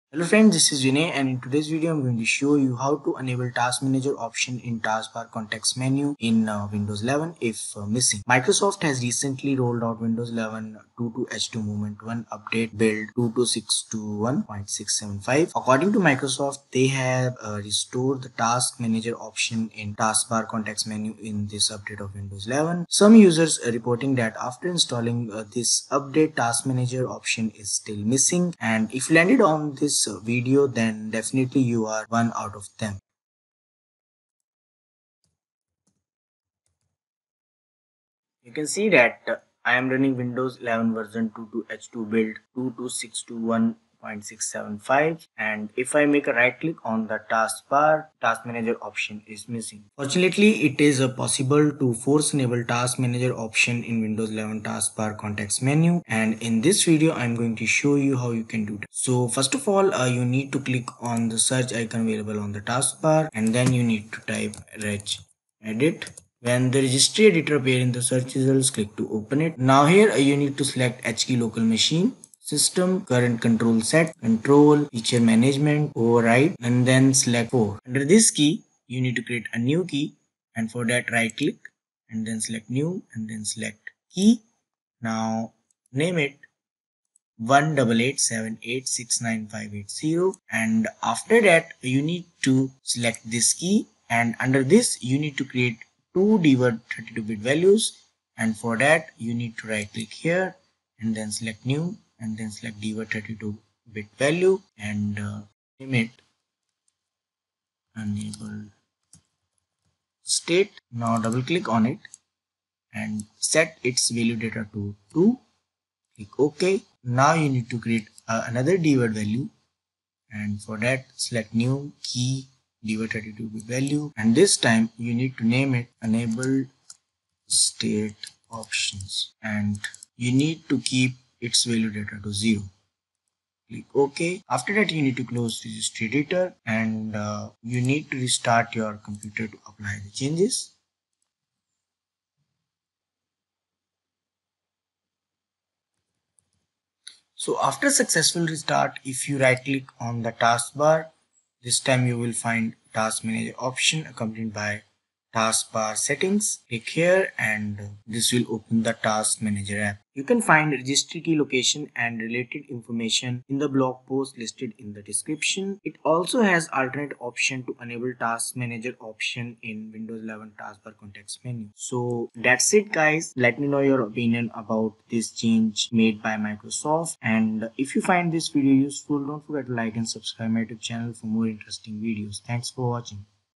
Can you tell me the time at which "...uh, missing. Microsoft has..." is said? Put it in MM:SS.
00:07.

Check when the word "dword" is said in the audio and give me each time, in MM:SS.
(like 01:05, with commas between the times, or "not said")
01:36, 01:42, 01:58, 02:02.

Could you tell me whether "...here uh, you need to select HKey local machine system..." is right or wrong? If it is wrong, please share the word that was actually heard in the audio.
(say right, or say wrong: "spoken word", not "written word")
right.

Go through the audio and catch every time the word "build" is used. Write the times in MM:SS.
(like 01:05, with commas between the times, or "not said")
00:12, 00:42.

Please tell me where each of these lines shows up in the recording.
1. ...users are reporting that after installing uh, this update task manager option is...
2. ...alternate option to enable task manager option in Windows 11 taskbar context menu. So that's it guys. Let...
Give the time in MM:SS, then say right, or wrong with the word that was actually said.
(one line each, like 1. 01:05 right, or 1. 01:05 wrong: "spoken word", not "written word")
1. 00:23 right
2. 02:46 right.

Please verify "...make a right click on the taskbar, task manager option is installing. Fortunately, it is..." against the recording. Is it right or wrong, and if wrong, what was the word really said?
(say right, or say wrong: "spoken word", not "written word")
wrong: "missing", not "installing".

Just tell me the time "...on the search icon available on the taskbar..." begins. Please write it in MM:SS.
01:01.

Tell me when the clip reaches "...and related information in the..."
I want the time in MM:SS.
02:41.